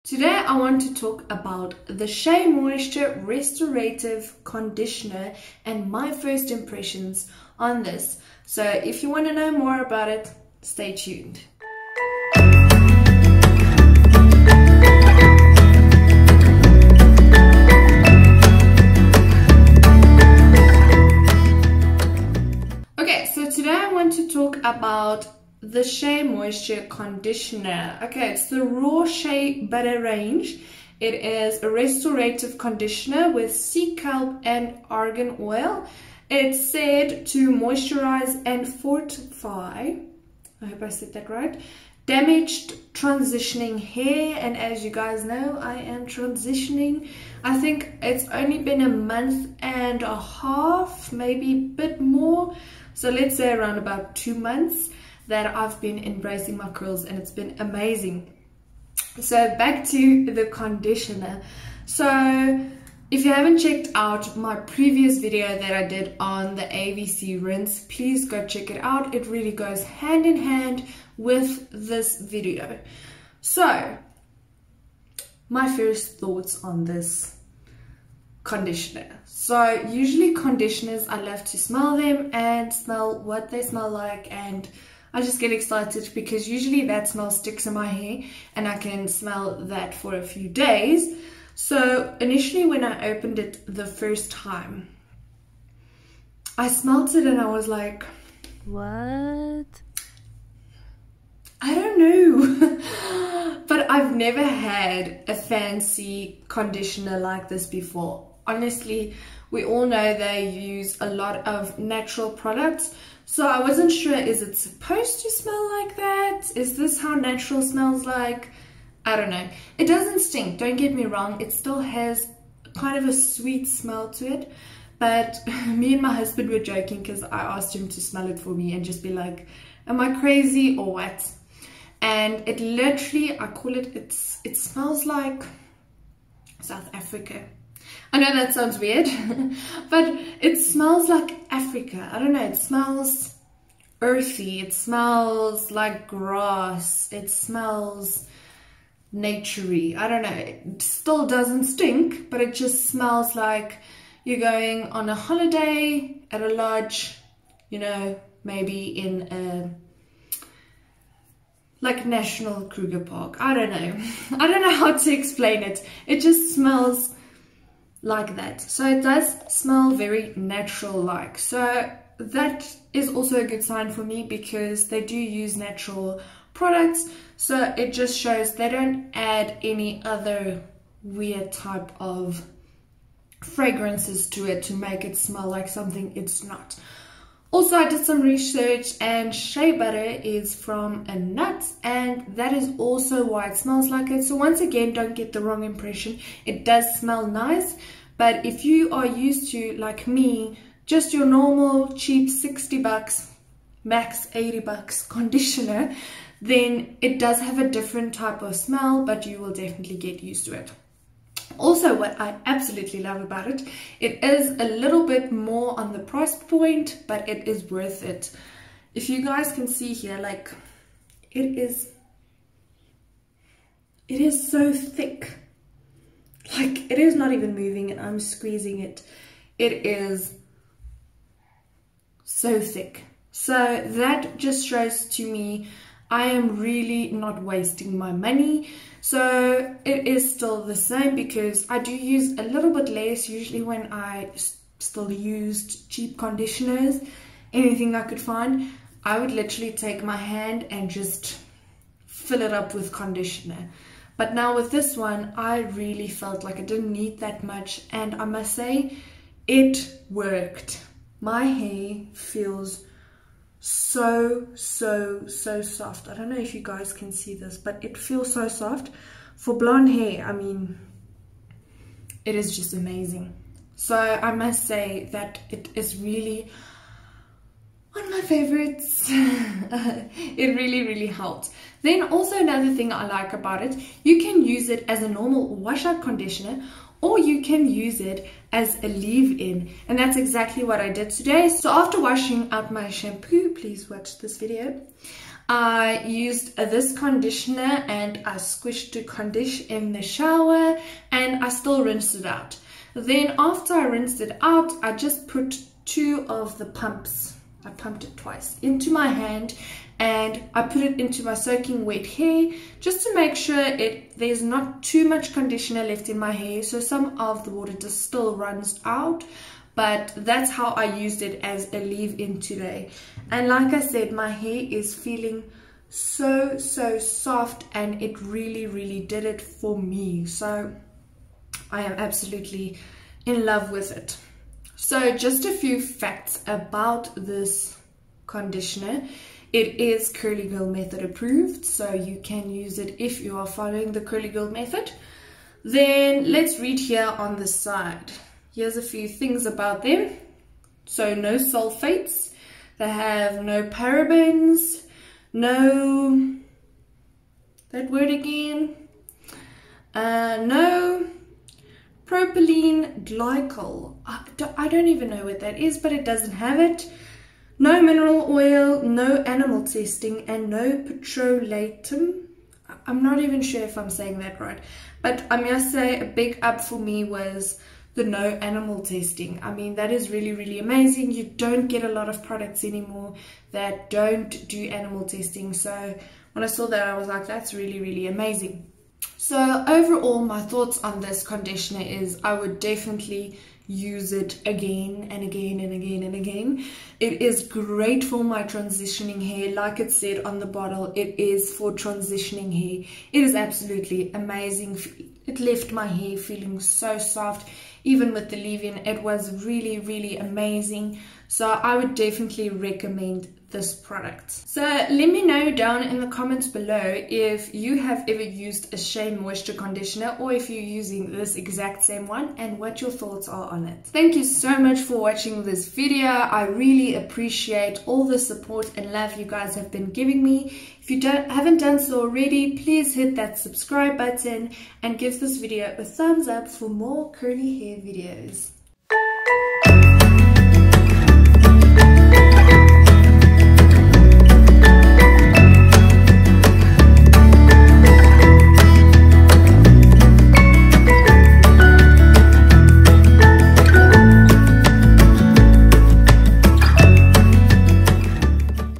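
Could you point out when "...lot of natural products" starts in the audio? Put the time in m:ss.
1:51.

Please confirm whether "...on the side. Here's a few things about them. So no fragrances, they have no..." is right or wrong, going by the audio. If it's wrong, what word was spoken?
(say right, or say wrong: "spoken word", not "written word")
wrong: "sulfates", not "fragrances".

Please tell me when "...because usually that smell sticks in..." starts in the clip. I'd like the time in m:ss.
1:26.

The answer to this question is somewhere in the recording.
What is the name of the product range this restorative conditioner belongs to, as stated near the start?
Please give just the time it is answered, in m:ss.
0:28.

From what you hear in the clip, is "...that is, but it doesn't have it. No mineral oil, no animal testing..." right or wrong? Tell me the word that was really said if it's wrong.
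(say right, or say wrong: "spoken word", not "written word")
right.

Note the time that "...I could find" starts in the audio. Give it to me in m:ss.
4:07.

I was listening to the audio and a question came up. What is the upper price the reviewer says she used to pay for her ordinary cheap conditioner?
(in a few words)
80 bucks.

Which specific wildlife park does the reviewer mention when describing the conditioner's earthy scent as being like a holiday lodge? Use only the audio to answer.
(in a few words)
Kruger Park.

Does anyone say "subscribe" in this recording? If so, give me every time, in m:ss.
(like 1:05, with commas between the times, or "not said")
7:13.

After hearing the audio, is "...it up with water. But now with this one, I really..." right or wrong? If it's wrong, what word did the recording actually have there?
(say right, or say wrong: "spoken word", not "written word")
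wrong: "conditioner", not "water".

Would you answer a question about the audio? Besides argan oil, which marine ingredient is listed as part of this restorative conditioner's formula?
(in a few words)
sea kelp.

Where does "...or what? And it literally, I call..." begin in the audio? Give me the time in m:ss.
2:10.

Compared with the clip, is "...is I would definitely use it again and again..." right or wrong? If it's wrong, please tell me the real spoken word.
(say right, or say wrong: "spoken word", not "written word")
right.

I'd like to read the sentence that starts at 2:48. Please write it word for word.
So it does smell very natural like.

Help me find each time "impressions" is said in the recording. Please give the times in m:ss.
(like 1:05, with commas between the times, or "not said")
0:06, 3:15.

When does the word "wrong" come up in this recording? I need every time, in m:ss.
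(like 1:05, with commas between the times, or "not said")
2:01, 3:15.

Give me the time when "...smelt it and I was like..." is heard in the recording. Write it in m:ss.
1:36.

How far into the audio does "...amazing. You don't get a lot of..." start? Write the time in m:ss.
6:20.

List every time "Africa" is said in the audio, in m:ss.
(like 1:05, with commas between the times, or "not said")
2:16, 2:21.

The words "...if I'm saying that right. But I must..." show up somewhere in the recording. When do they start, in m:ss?
6:13.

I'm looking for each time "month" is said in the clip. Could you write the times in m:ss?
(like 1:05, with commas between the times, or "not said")
0:48, 0:54.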